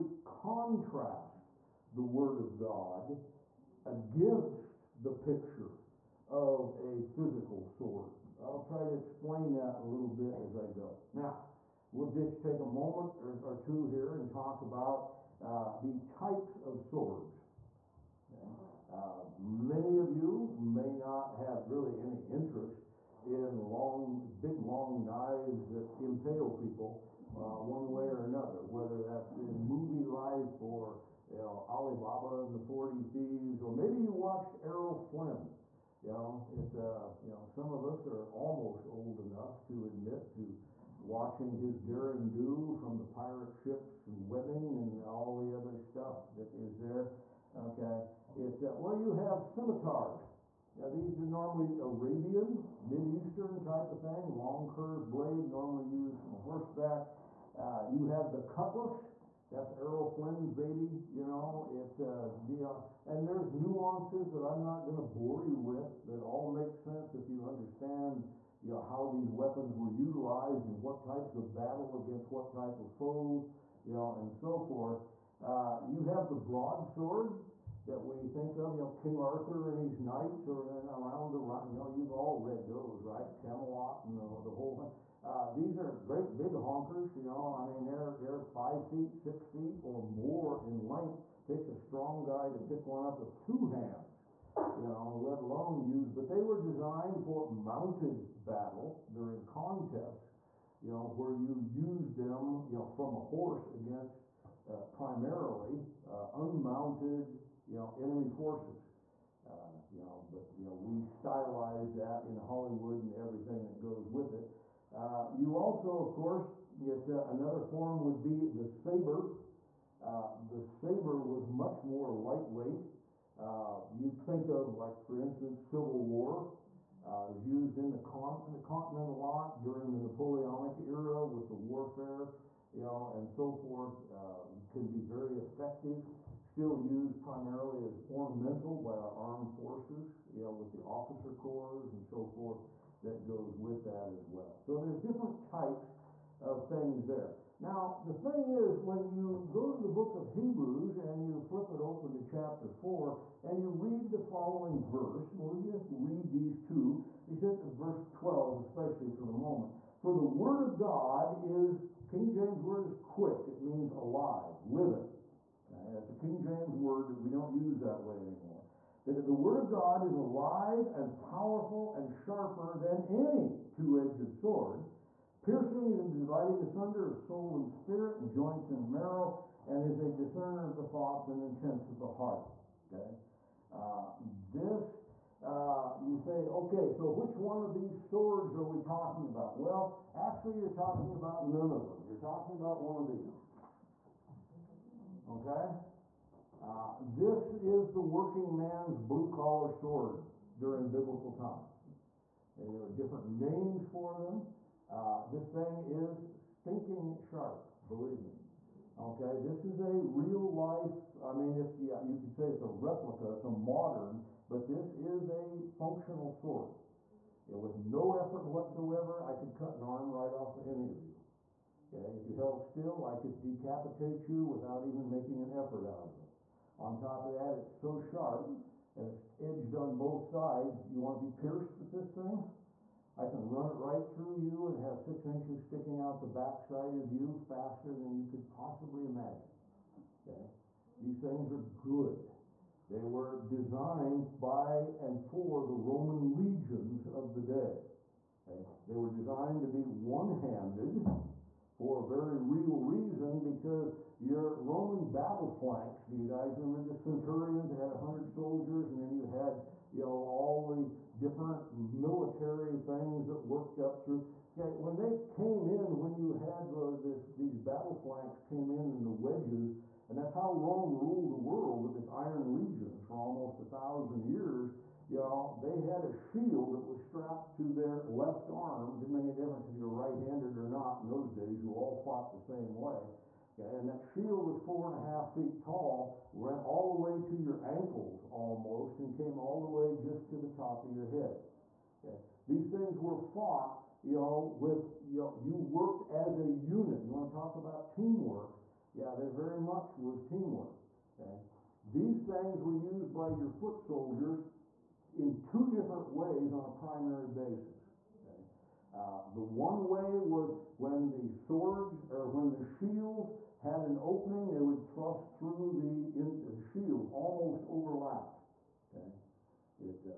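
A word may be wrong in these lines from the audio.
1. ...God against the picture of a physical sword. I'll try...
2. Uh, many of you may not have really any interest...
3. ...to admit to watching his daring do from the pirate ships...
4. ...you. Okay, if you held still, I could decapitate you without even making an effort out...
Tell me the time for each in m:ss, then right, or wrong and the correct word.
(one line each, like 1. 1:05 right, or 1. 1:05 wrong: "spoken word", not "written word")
1. 0:02 right
2. 0:18 right
3. 0:39 right
4. 3:41 right.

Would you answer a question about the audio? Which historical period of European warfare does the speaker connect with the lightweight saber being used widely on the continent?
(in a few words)
Napoleonic era.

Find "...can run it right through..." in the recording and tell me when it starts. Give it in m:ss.
3:53.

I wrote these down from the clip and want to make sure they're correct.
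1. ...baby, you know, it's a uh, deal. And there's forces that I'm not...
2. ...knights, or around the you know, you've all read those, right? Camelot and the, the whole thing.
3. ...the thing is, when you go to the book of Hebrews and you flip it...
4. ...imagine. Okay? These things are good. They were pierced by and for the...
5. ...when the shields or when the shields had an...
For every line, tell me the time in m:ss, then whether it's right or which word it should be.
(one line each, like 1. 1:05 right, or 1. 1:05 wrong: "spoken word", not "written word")
1. 1:00 wrong: "nuances", not "forces"
2. 1:19 right
3. 2:28 right
4. 3:59 wrong: "designed", not "pierced"
5. 5:10 wrong: "swords", not "shields".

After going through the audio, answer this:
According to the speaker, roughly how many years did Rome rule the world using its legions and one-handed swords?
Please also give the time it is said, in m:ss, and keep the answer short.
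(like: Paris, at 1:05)
1000, at 4:33.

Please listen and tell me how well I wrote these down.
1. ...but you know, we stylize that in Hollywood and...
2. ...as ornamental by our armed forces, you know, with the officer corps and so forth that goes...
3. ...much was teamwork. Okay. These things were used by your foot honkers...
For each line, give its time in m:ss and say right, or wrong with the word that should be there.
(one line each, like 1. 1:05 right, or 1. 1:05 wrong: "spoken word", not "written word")
1. 1:50 right
2. 2:17 right
3. 4:59 wrong: "soldiers", not "honkers".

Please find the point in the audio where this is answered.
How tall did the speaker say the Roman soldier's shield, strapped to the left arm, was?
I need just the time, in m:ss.
4:44.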